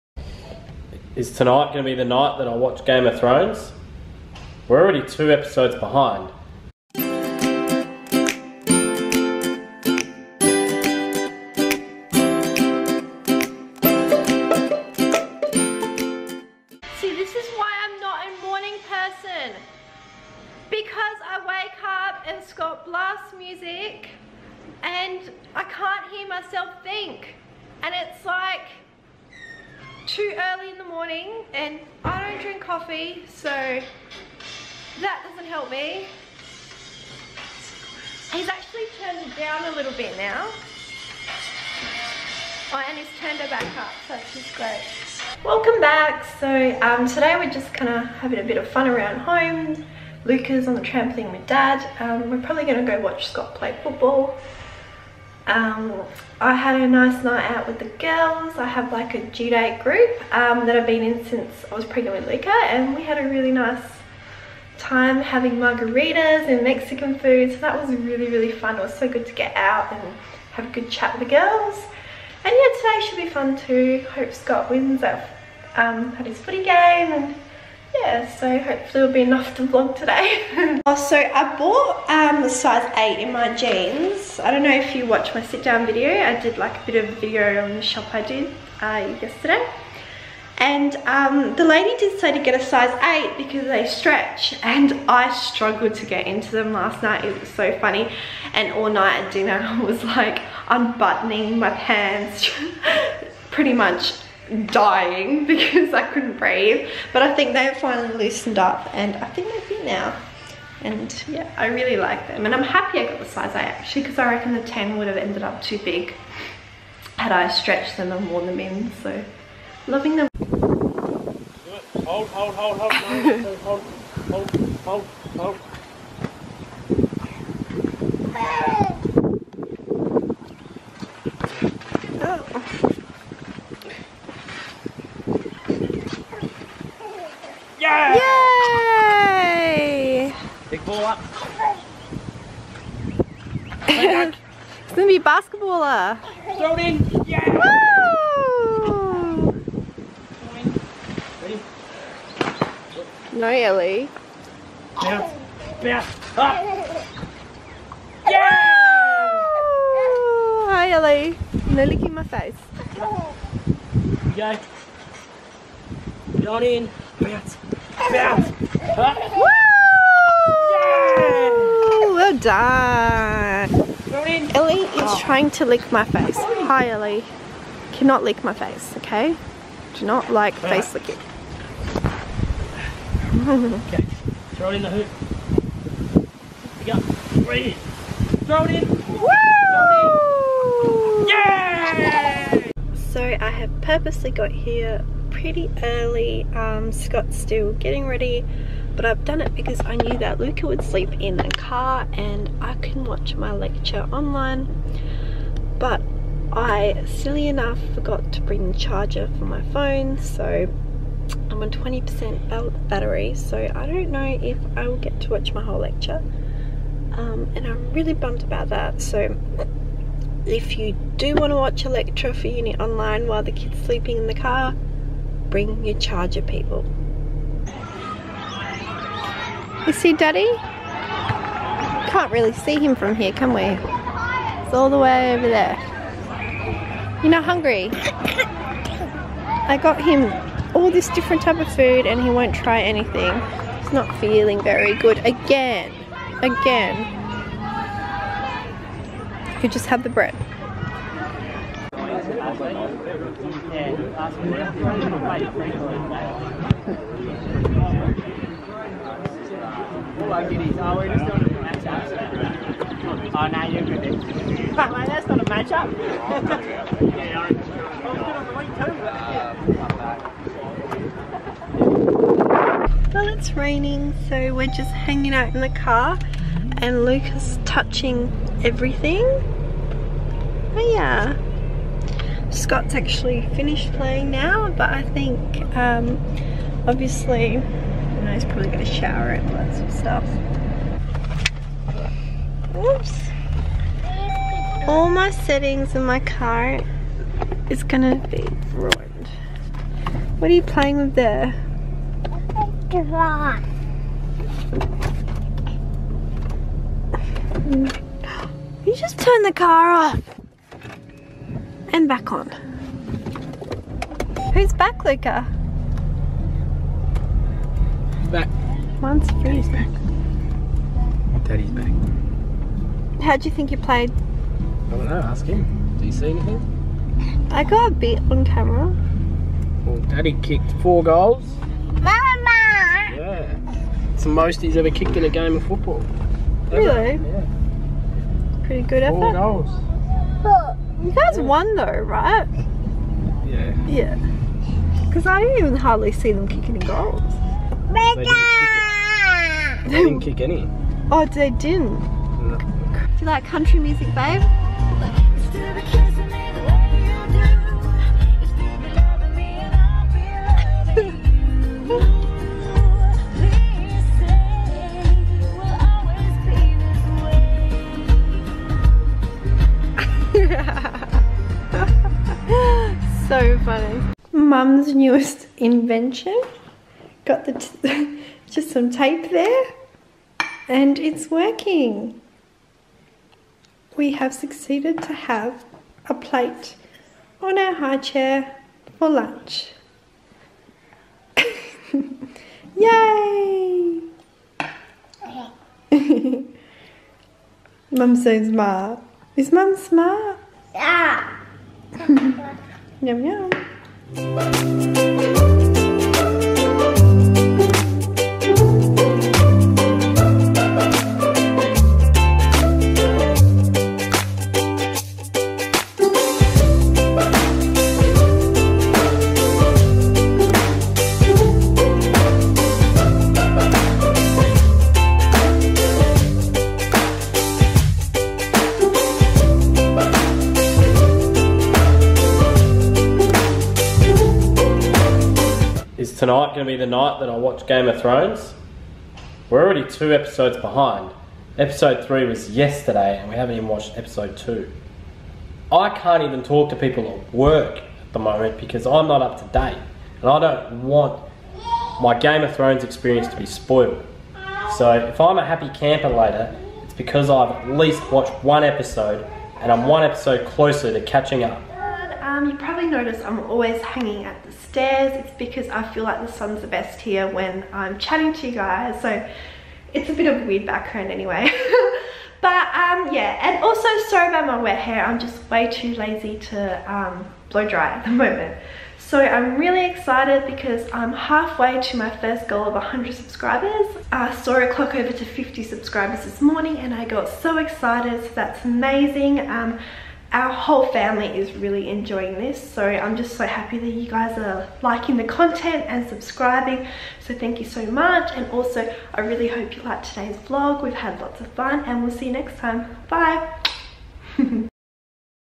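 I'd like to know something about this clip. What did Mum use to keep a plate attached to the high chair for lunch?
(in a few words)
Tape.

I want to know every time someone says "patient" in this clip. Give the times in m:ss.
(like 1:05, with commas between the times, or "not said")
not said.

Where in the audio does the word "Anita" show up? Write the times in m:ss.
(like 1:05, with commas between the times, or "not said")
not said.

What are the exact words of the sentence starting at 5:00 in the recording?
What are you playing with there?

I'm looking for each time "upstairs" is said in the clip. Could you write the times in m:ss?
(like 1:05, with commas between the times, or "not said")
7:44.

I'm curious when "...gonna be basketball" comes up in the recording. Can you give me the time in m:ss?
2:24.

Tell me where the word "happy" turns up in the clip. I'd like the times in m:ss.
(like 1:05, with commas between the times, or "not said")
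1:52, 7:35, 8:13.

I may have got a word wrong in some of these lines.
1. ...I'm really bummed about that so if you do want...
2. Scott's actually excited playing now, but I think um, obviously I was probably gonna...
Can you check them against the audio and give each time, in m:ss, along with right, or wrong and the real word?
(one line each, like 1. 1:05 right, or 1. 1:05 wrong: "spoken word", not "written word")
1. 3:37 right
2. 4:42 wrong: "finished", not "excited".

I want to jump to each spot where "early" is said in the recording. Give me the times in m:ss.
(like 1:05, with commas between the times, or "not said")
0:30, 3:15.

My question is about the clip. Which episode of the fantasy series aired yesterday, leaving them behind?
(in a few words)
3.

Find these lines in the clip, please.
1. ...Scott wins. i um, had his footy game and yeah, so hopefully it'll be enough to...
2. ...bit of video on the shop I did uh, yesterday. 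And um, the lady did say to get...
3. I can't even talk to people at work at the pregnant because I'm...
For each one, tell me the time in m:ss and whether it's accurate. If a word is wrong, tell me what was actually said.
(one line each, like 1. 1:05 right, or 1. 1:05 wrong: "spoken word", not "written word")
1. 1:14 right
2. 1:26 right
3. 7:25 wrong: "moment", not "pregnant".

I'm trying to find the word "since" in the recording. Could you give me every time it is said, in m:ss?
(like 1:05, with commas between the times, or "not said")
1:01.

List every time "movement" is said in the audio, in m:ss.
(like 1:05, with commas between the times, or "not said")
not said.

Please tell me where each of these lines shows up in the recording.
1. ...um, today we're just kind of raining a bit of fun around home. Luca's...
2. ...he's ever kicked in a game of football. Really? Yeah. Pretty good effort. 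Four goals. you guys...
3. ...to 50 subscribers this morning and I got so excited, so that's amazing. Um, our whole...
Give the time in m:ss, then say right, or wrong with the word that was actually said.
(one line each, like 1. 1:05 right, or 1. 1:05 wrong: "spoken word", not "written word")
1. 0:46 wrong: "having", not "raining"
2. 5:34 right
3. 8:05 right.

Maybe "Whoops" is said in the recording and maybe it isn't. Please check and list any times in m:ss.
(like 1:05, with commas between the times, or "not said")
4:52.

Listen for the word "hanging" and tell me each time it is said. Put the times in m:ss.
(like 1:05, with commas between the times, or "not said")
4:34, 7:43.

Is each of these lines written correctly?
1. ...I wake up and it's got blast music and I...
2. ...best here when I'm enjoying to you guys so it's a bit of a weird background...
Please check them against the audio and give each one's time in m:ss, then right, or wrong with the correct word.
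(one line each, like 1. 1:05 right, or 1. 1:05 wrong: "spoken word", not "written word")
1. 0:21 right
2. 7:46 wrong: "chatting", not "enjoying".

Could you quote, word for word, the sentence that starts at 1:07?
So that was really, really fun.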